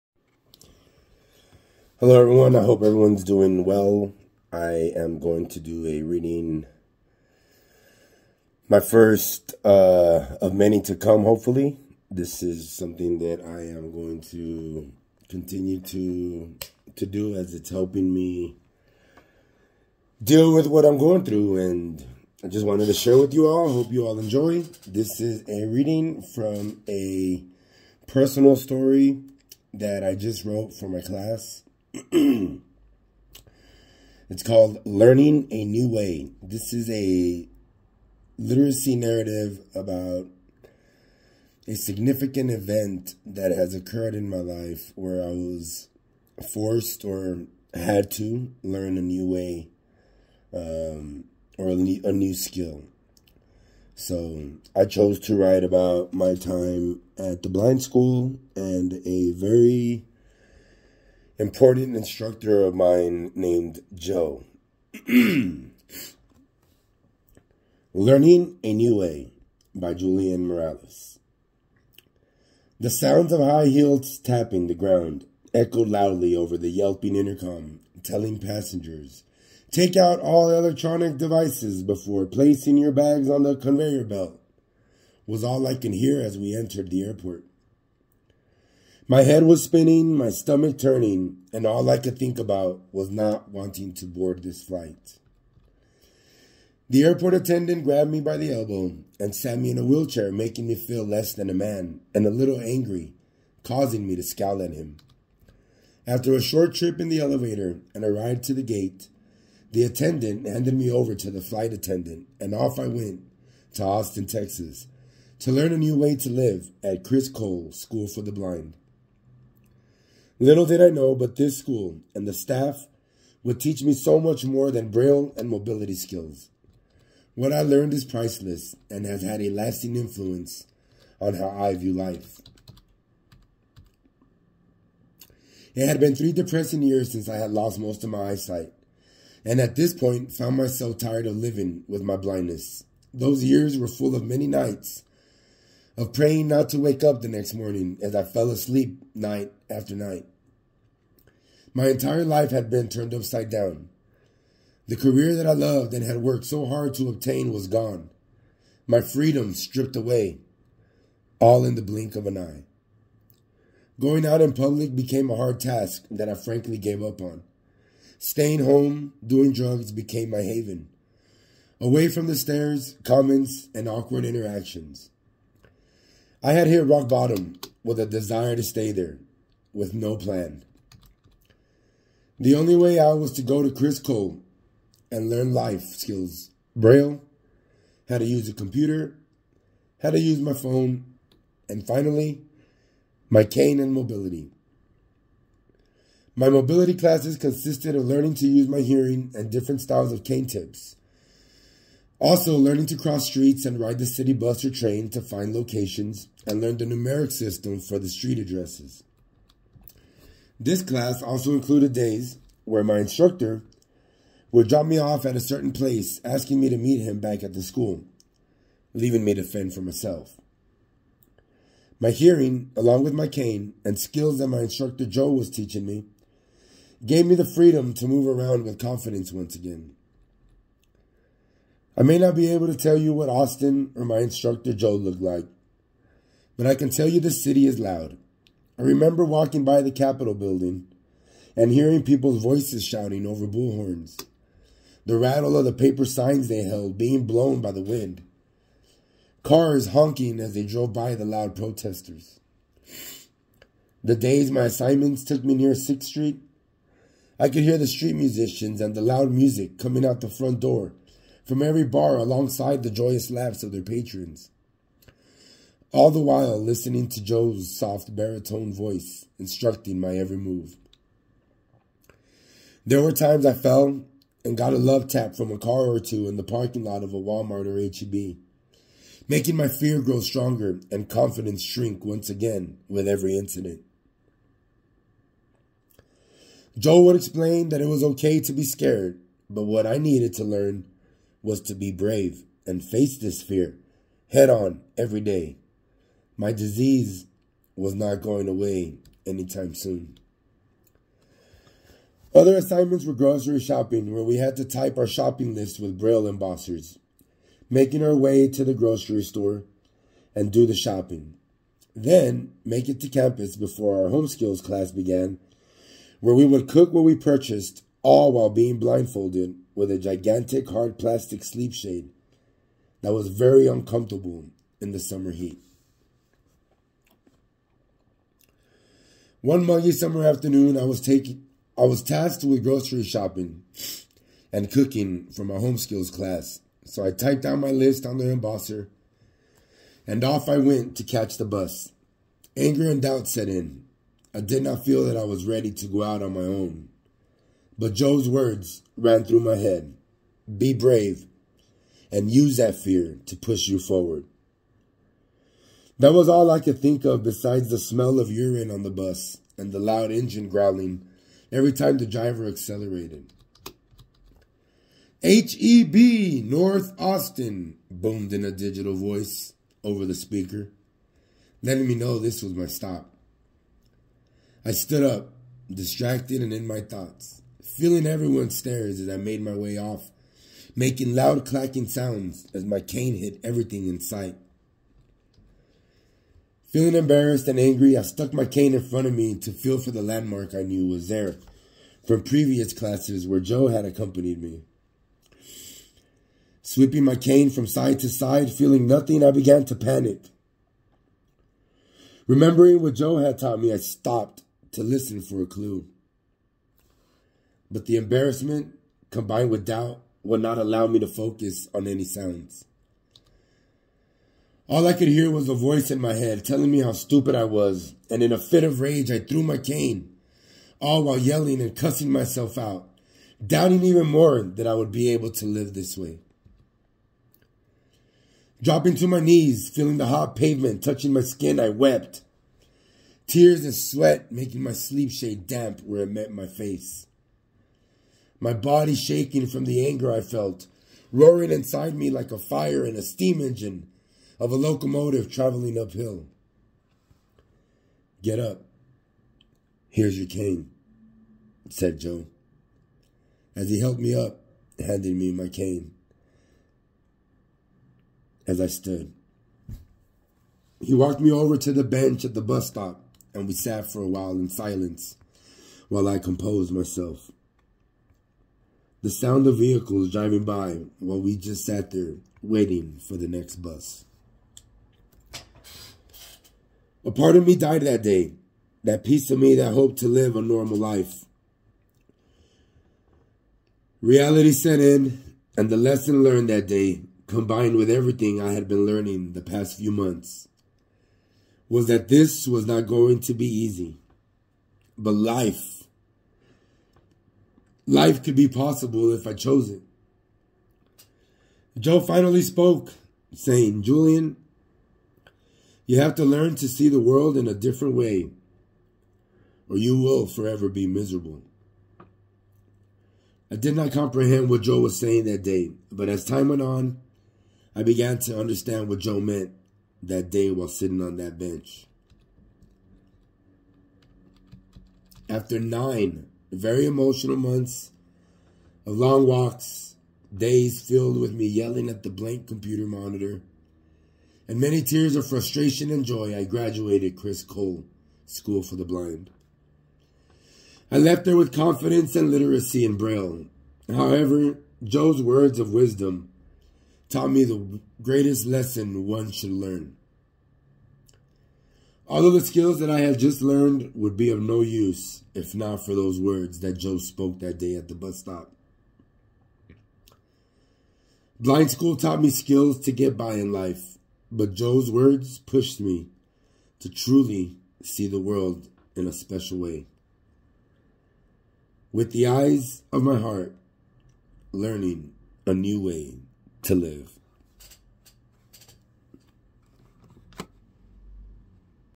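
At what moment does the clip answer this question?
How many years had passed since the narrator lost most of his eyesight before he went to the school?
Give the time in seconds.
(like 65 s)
136 s.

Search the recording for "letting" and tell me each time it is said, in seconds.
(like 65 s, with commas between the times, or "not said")
371 s.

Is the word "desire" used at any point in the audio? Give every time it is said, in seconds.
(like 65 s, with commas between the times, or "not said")
178 s.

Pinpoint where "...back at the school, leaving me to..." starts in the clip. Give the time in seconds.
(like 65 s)
217 s.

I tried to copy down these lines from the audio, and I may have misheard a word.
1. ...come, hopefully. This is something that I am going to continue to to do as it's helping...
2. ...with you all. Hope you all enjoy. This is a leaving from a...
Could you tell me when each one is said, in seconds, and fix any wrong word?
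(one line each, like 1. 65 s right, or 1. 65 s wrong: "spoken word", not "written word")
1. 10 s right
2. 23 s wrong: "reading", not "leaving".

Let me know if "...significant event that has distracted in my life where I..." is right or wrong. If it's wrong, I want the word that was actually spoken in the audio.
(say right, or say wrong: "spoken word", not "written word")
wrong: "occurred", not "distracted".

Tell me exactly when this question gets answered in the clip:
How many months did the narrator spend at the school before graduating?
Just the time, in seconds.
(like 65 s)
525 s.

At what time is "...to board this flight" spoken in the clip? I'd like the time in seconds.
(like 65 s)
93 s.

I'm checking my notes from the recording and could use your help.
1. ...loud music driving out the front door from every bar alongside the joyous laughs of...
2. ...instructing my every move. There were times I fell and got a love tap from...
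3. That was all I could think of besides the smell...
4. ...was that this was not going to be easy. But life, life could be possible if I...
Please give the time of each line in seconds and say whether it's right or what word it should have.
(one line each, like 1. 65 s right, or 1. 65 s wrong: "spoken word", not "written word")
1. 259 s wrong: "coming", not "driving"
2. 269 s right
3. 356 s right
4. 491 s right.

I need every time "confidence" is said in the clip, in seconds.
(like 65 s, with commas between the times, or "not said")
228 s, 281 s, 541 s.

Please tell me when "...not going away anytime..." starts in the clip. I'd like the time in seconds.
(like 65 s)
297 s.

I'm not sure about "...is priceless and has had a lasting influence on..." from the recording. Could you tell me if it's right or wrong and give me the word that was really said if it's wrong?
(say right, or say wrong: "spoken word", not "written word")
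right.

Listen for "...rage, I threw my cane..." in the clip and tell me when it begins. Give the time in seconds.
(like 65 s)
418 s.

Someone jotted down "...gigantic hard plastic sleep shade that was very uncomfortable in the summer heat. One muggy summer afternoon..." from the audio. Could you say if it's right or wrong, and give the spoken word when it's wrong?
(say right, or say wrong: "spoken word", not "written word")
right.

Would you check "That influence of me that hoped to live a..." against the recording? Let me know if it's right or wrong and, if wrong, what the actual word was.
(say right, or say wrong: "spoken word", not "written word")
wrong: "piece", not "influence".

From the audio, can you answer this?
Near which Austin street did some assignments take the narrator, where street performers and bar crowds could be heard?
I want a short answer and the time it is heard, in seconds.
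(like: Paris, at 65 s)
6th Street, at 255 s.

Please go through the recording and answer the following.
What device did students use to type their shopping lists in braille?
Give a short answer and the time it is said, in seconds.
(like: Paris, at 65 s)
braille embossers, at 305 s.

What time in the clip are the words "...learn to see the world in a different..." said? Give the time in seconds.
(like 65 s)
506 s.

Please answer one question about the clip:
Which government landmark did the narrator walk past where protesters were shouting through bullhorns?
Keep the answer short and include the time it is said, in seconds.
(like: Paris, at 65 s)
the Capitol building, at 239 s.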